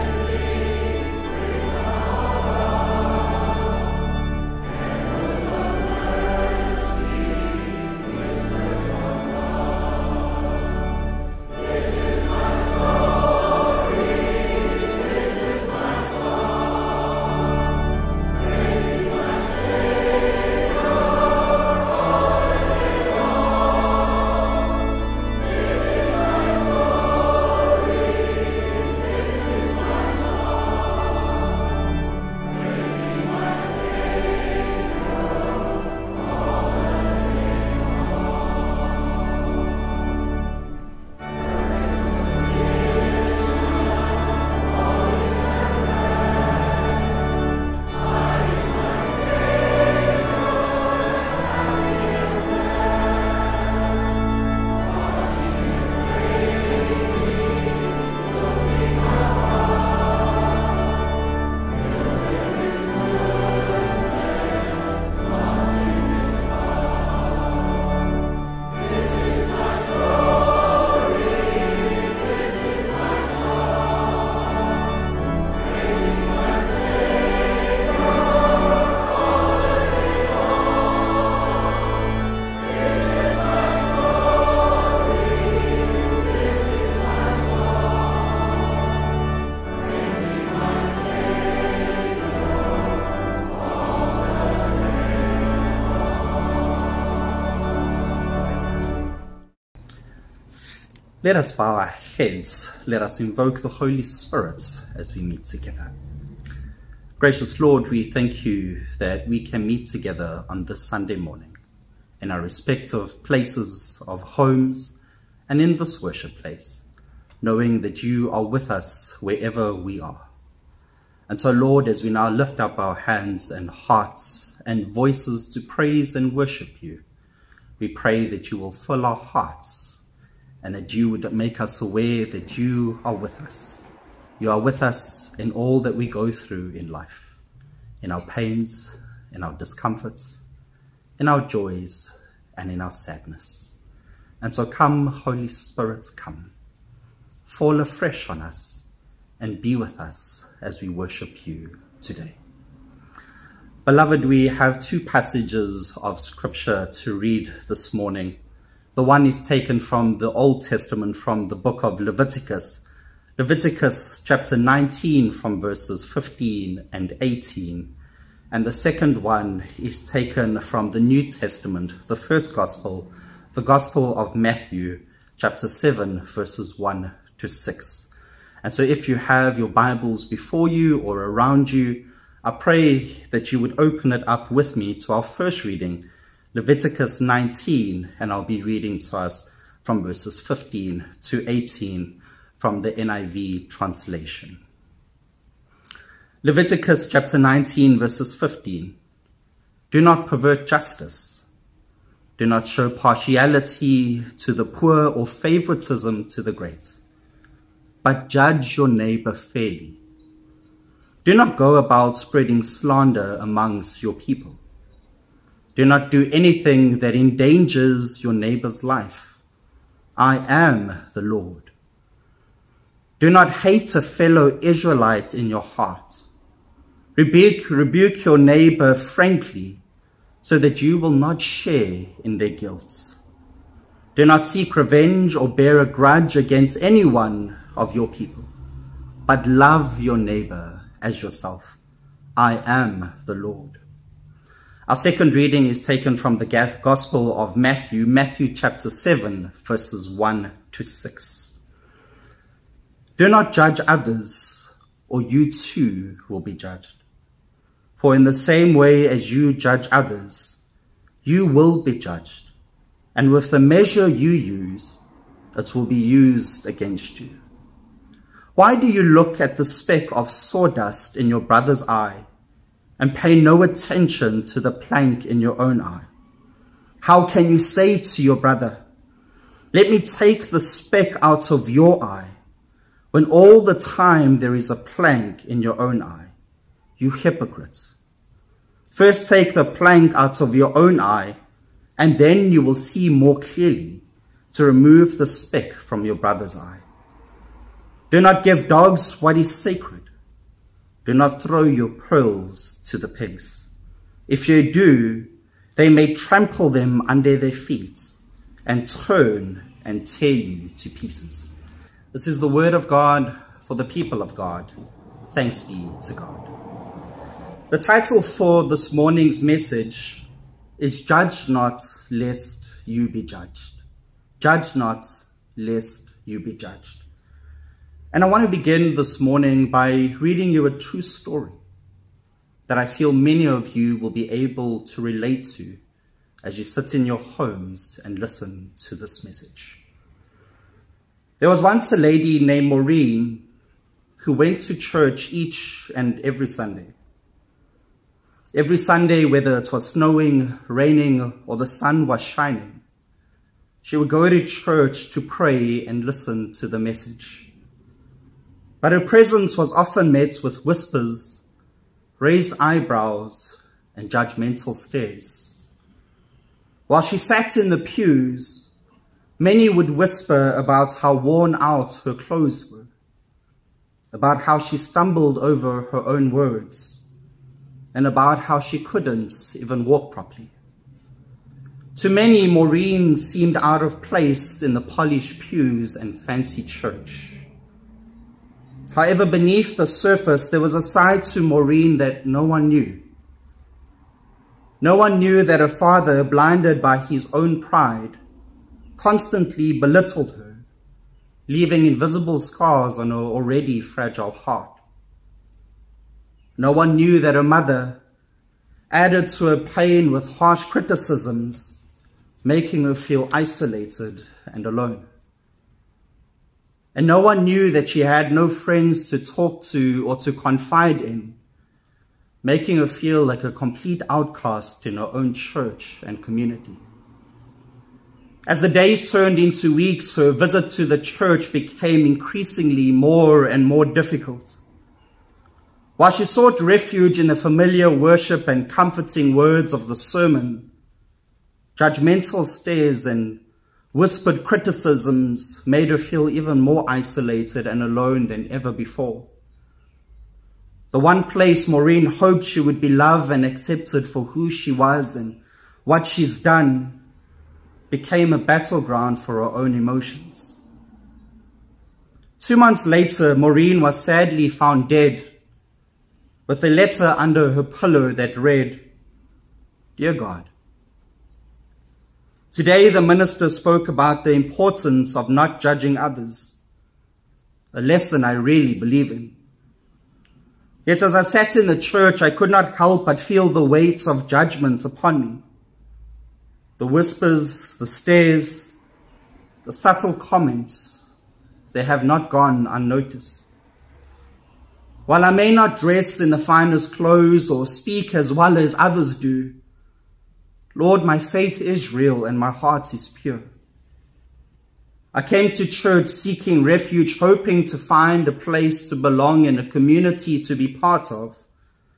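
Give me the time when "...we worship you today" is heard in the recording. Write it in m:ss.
2:30.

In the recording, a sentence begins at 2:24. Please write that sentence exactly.
And so come, Holy Spirit, come.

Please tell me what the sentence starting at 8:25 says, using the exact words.
I came to church seeking refuge, hoping to find a place to belong and a community to be part of.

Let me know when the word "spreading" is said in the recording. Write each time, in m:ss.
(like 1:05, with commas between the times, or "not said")
3:32.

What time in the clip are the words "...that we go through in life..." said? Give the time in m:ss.
2:15.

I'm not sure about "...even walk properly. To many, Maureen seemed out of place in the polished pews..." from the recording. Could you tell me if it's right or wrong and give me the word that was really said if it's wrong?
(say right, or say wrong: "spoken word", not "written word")
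right.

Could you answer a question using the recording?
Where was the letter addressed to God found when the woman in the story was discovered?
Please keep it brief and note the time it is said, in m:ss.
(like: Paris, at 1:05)
Under her pillow, at 7:47.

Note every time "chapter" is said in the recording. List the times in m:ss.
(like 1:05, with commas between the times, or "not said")
2:44, 2:55, 3:17, 4:08.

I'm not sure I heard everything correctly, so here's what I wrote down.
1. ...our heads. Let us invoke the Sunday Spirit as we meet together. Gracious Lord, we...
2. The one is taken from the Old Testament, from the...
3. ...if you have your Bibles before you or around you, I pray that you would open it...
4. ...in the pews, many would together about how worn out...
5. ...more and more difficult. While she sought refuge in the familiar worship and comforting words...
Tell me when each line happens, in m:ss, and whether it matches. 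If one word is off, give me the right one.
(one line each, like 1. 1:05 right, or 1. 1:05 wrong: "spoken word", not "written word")
1. 1:41 wrong: "Holy", not "Sunday"
2. 2:38 right
3. 2:58 right
4. 6:07 wrong: "whisper", not "together"
5. 7:12 right.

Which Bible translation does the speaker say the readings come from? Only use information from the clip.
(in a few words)
NIV.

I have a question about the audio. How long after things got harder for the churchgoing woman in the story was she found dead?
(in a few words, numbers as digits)
Two months.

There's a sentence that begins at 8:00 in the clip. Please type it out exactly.
Yet, as I sat in the church, I could not help but feel the weights of judgments upon me.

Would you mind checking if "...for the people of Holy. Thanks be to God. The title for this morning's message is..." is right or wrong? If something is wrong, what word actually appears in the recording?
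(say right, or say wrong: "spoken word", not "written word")
wrong: "God", not "Holy".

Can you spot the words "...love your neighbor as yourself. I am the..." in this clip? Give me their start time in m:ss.
3:59.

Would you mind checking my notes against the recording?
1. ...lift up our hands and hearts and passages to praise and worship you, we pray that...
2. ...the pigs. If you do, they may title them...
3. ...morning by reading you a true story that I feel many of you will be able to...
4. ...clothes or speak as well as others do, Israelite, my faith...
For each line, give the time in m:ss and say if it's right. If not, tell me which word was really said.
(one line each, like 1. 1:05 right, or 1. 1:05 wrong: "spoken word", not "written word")
1. 2:02 wrong: "voices", not "passages"
2. 5:02 wrong: "trample", not "title"
3. 5:29 right
4. 8:16 wrong: "Lord", not "Israelite".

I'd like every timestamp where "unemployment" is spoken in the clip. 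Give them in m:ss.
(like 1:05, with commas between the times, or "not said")
not said.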